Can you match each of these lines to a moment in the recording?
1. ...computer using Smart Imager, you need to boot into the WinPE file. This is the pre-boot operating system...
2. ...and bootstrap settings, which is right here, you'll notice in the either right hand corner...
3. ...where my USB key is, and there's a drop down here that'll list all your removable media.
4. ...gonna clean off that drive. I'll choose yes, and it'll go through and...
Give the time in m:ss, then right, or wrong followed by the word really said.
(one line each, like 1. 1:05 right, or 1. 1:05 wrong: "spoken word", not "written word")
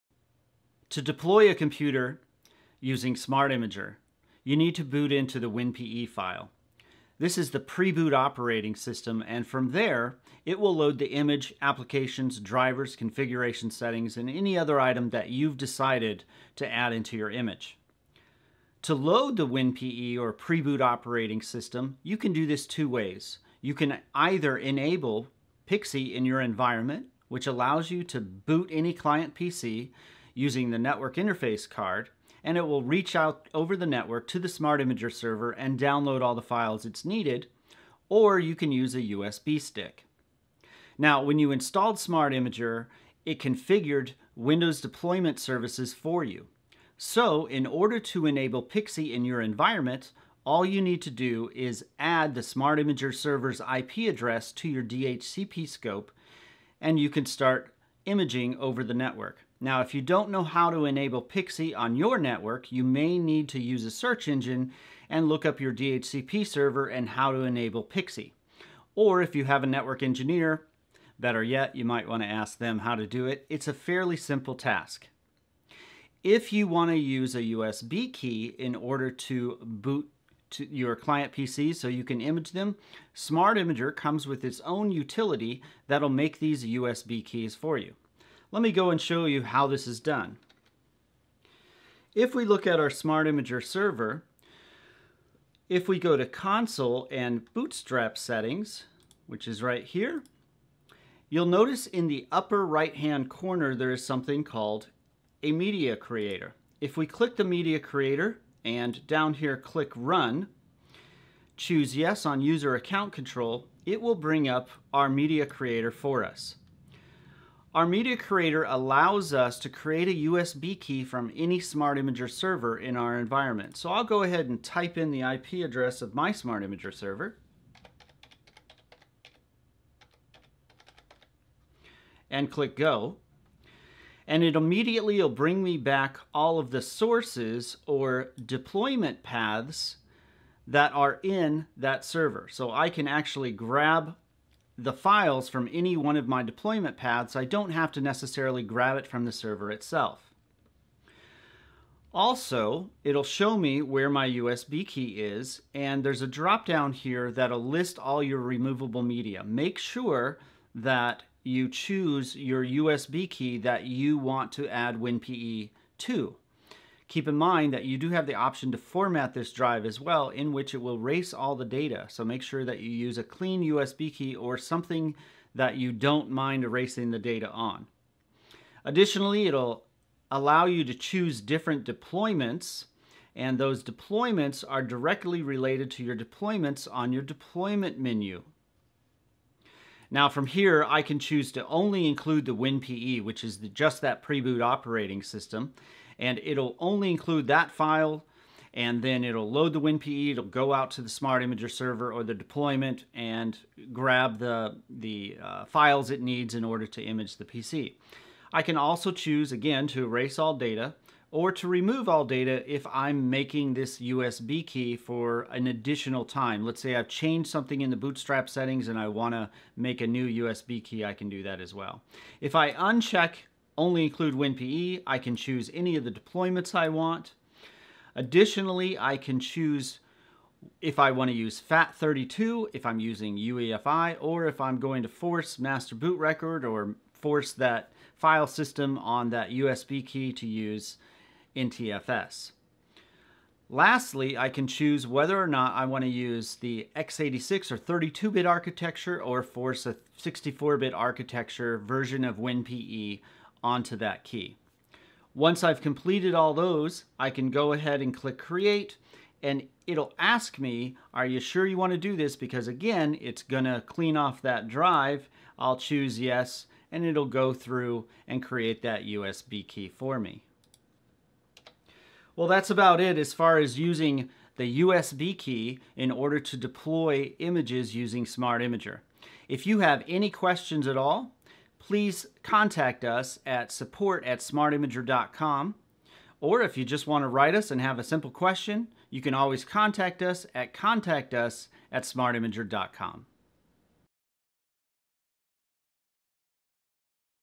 1. 0:01 right
2. 1:37 wrong: "upper", not "either"
3. 2:33 right
4. 4:23 right.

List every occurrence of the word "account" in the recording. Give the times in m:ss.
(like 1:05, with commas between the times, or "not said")
1:52.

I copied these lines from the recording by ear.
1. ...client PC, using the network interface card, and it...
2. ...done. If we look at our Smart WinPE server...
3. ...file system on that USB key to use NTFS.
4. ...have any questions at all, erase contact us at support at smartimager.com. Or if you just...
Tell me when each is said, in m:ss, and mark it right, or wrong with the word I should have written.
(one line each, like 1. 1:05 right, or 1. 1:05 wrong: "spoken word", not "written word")
1. 0:28 right
2. 1:30 wrong: "Imager", not "WinPE"
3. 3:58 right
4. 4:39 wrong: "please", not "erase".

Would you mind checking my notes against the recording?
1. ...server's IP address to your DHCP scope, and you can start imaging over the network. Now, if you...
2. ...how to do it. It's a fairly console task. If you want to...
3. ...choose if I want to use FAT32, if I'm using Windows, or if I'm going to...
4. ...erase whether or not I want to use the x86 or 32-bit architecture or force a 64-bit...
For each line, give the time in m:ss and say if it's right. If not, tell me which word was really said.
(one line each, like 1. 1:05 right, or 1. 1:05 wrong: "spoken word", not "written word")
1. 0:53 right
2. 1:12 wrong: "simple", not "console"
3. 3:49 wrong: "UEFI", not "Windows"
4. 4:04 wrong: "choose", not "erase".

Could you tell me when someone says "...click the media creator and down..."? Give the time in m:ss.
1:47.